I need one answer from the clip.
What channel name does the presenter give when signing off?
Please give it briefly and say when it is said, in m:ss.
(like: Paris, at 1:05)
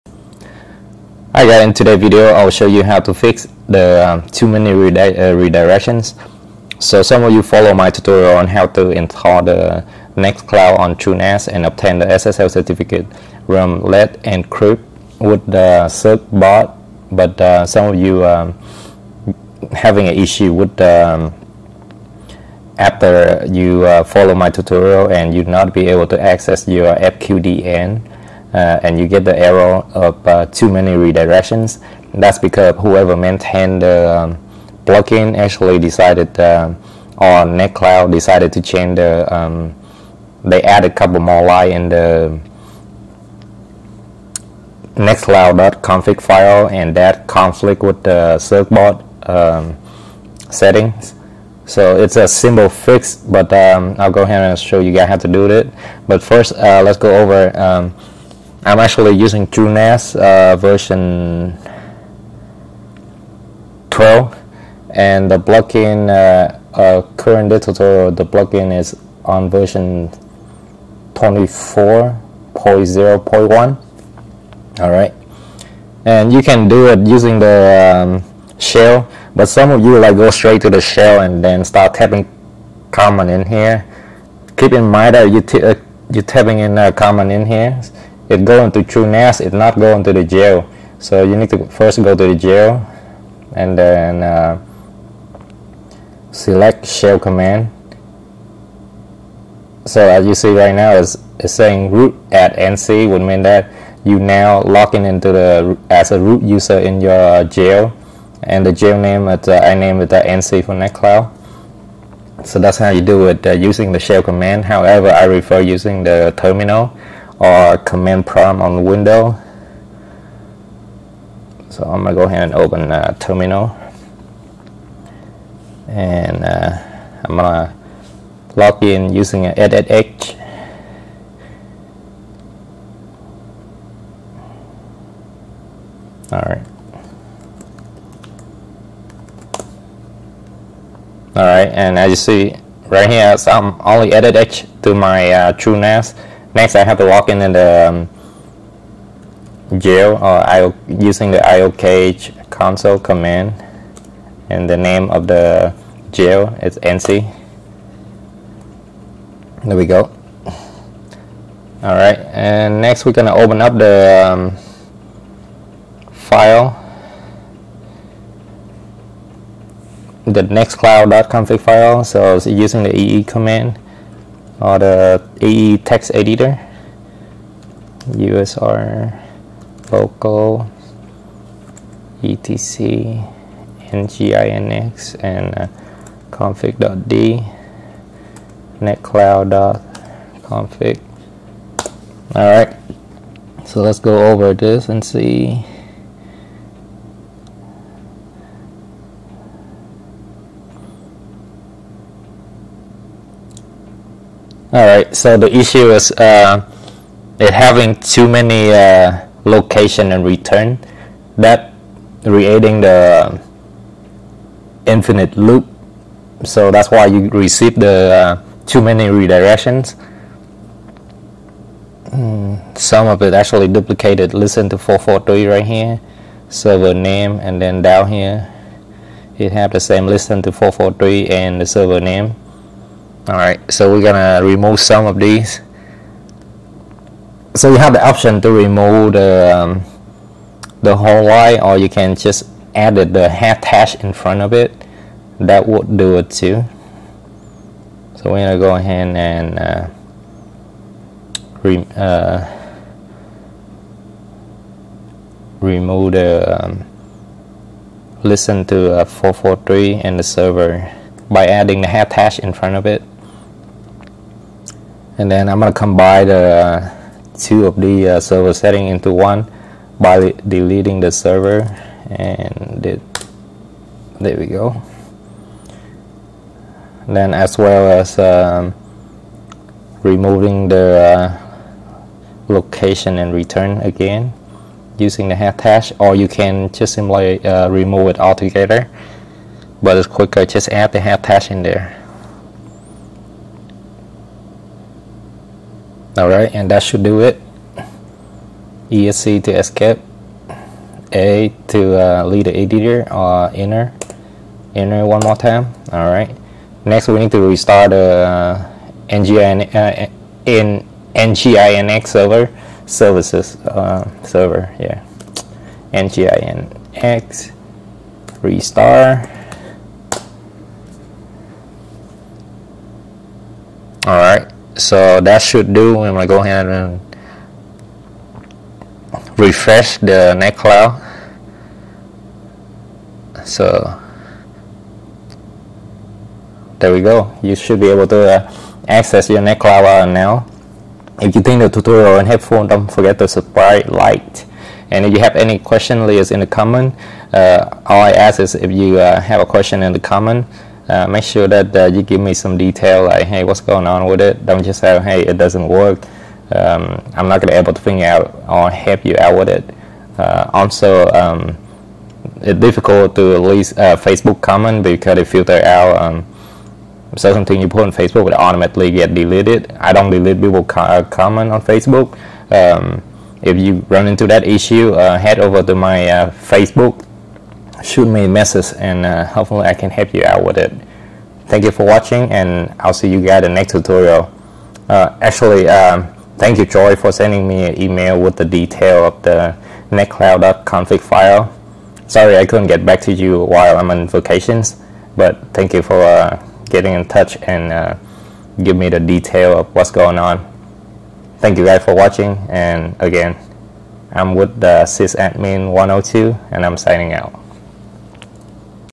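sysadmin 102, at 6:44.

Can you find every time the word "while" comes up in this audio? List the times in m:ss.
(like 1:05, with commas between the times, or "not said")
6:33.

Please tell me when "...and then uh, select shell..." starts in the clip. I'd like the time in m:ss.
1:33.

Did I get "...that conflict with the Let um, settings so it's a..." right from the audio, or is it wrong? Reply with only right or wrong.
wrong.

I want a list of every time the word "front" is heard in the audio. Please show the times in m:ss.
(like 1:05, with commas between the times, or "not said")
4:04, 4:22.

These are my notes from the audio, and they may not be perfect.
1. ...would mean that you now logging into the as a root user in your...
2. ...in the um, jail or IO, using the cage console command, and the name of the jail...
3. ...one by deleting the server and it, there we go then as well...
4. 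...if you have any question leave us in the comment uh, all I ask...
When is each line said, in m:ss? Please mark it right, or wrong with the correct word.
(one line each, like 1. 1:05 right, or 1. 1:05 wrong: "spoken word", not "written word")
1. 1:43 right
2. 2:27 right
3. 4:29 right
4. 5:45 right.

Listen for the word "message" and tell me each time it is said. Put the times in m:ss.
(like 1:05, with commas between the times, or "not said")
6:18.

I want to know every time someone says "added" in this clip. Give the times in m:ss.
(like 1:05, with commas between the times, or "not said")
2:24.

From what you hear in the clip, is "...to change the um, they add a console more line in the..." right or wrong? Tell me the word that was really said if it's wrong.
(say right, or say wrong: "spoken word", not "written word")
wrong: "couple", not "console".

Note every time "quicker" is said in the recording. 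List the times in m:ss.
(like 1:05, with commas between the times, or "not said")
4:50.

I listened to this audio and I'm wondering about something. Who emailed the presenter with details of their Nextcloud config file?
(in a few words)
Joy.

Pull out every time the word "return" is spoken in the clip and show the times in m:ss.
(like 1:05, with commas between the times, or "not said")
3:30, 4:43.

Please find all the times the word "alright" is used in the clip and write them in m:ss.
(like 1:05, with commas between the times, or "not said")
3:53.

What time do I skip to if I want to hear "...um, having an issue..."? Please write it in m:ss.
0:18.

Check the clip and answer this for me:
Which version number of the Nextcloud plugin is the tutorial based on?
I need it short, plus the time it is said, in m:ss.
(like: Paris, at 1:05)
24.0.1, at 1:11.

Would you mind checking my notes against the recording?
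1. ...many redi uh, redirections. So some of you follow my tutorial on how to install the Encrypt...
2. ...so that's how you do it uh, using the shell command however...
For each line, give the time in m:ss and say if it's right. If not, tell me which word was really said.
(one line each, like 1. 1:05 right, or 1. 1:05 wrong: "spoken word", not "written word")
1. 0:04 wrong: "Nextcloud", not "Encrypt"
2. 1:52 right.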